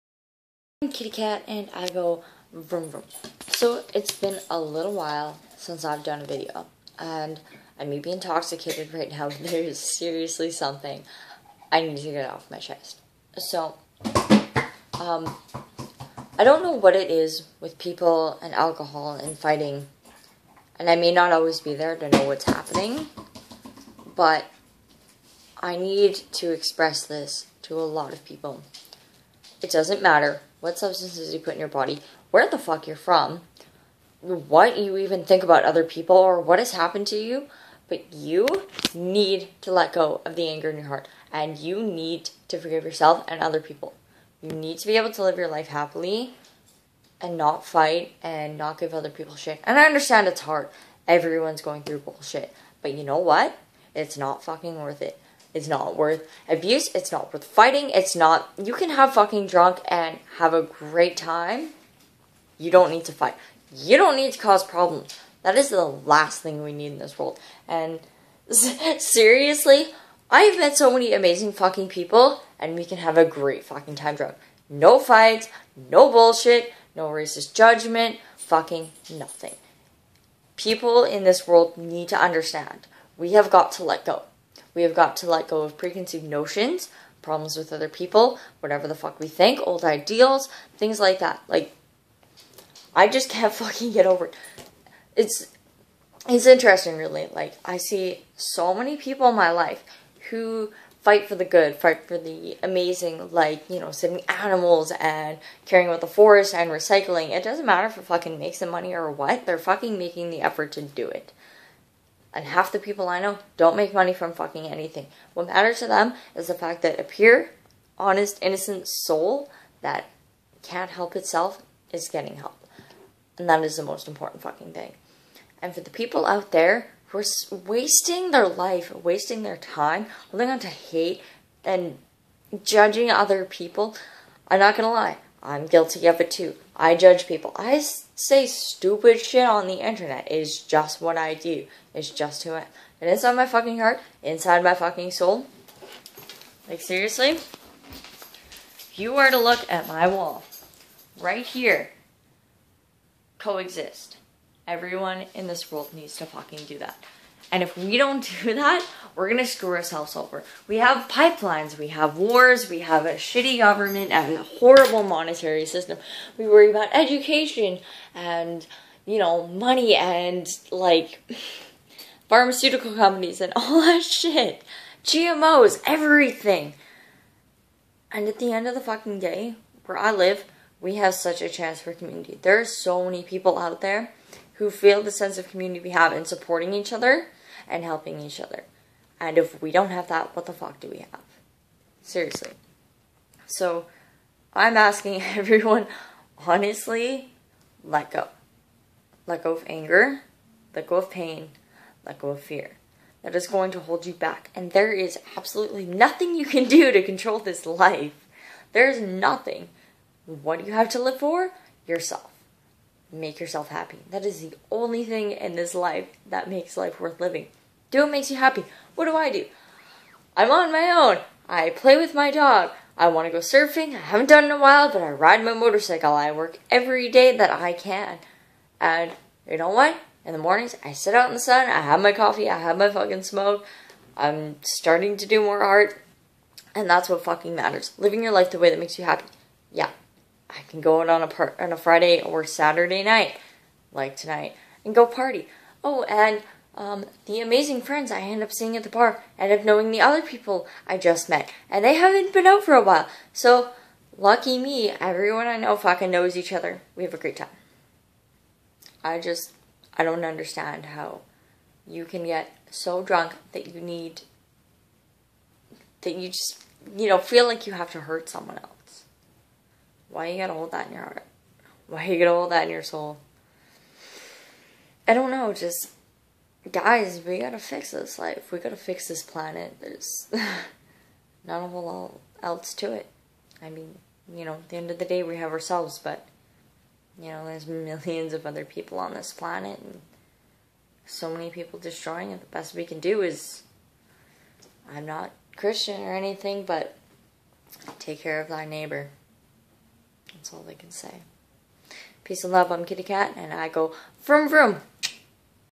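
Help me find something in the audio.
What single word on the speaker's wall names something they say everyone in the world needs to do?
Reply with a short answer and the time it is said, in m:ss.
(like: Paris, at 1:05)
coexist, at 2:33.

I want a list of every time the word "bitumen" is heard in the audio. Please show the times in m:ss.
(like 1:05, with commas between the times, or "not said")
not said.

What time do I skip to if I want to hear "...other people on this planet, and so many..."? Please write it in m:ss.
4:48.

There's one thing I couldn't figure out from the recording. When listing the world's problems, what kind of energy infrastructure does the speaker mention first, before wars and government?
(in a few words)
pipelines.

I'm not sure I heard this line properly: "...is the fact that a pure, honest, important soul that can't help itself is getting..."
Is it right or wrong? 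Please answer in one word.
wrong.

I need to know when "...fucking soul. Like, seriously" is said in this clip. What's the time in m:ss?
2:24.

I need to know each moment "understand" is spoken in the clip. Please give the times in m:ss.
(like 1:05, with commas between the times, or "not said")
0:49, 1:22, 4:20.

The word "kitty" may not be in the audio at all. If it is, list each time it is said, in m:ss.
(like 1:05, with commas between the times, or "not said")
0:00, 5:02.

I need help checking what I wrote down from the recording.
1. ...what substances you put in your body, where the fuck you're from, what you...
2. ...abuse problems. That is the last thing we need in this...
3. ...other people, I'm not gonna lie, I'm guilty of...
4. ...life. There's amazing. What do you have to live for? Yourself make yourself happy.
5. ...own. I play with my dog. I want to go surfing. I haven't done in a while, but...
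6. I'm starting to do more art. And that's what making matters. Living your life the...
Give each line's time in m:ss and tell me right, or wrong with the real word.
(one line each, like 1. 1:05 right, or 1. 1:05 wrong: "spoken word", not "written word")
1. 0:30 right
2. 1:04 wrong: "cause", not "abuse"
3. 2:13 right
4. 3:27 wrong: "nothing", not "amazing"
5. 3:40 right
6. 3:54 wrong: "fucking", not "making".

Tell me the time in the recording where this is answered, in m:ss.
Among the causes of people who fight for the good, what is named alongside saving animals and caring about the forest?
1:46.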